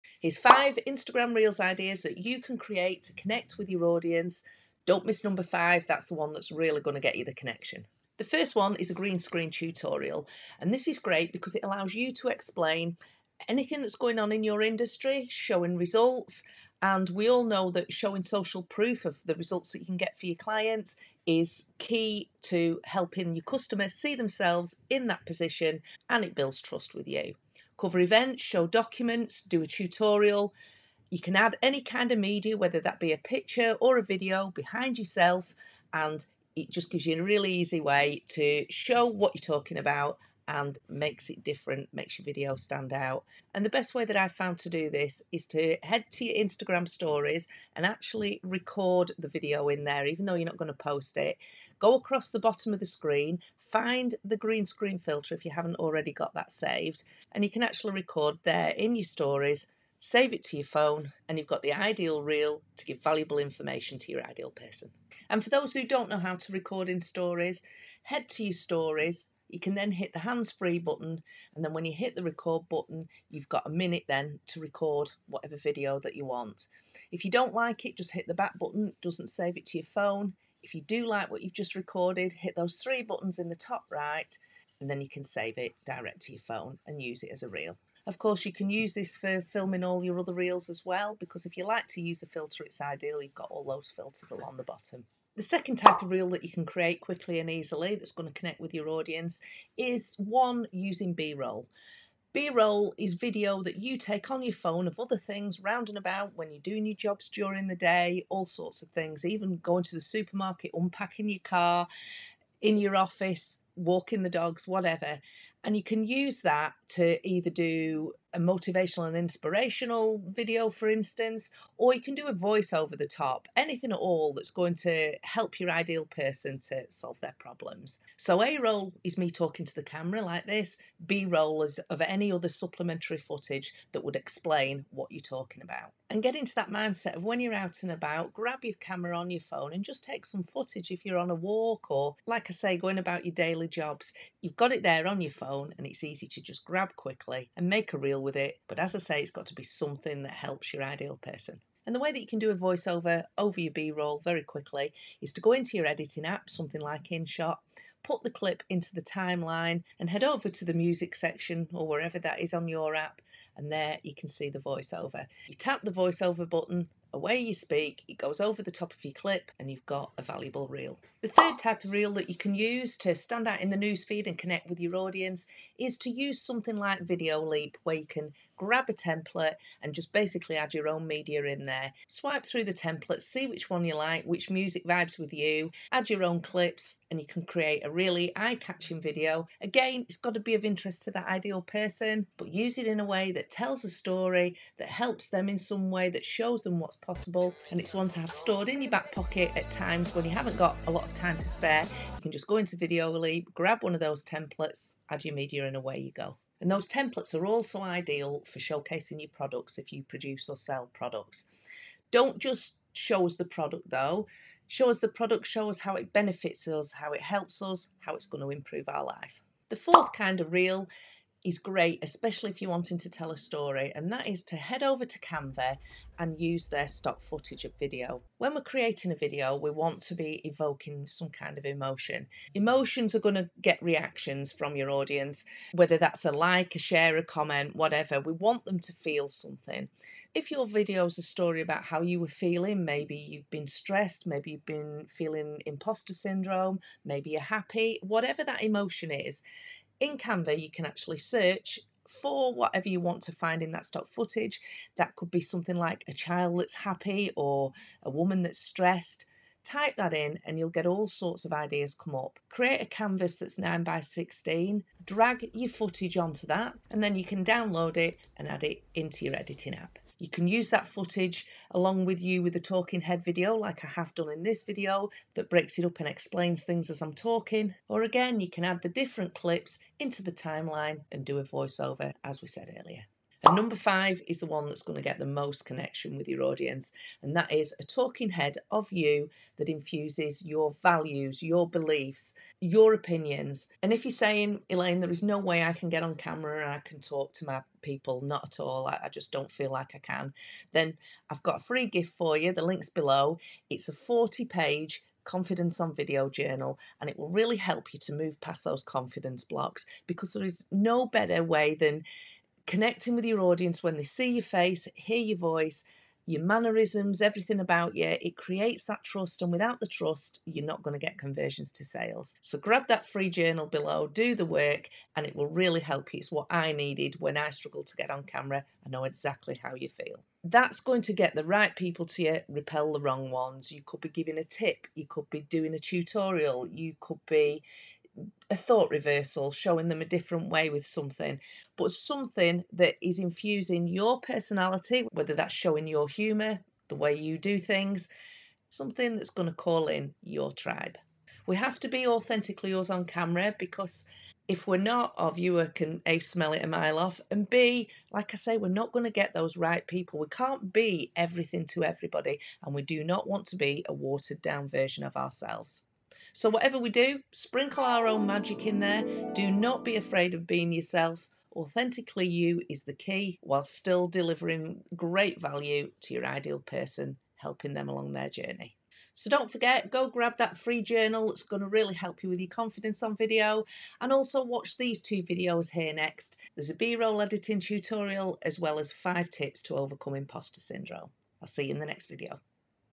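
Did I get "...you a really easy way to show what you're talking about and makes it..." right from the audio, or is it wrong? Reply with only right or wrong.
right.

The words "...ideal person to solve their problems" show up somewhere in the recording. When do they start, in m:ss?
2:05.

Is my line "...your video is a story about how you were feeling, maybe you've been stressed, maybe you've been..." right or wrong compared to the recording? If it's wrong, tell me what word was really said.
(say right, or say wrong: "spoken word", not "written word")
right.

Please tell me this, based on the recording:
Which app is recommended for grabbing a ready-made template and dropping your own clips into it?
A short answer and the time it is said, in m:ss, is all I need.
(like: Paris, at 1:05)
Videoleap, at 2:57.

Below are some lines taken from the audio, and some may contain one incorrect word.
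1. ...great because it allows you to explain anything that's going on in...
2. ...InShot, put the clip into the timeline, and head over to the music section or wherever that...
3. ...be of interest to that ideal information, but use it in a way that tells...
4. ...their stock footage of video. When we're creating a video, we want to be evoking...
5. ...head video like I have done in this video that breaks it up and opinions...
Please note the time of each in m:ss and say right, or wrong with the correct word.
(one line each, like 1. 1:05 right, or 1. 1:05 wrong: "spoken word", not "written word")
1. 0:10 right
2. 2:37 right
3. 3:10 wrong: "person", not "information"
4. 3:46 right
5. 4:33 wrong: "explains", not "opinions".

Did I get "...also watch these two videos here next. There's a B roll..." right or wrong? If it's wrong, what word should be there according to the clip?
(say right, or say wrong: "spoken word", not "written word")
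right.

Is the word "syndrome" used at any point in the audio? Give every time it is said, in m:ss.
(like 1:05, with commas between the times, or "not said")
4:06, 6:30.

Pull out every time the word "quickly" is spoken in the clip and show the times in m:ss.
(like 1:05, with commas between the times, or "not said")
1:36, 2:26, 2:34.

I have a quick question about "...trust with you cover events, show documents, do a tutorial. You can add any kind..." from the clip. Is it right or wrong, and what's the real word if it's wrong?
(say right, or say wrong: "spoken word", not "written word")
right.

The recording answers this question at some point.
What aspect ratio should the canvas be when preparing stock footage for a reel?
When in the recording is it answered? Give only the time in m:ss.
4:23.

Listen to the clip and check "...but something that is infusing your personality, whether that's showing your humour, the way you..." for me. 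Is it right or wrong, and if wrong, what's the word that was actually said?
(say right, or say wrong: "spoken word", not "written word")
right.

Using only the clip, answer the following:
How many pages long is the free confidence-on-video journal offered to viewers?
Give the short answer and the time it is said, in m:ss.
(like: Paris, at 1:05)
40, at 5:03.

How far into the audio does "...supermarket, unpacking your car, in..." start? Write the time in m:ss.
1:50.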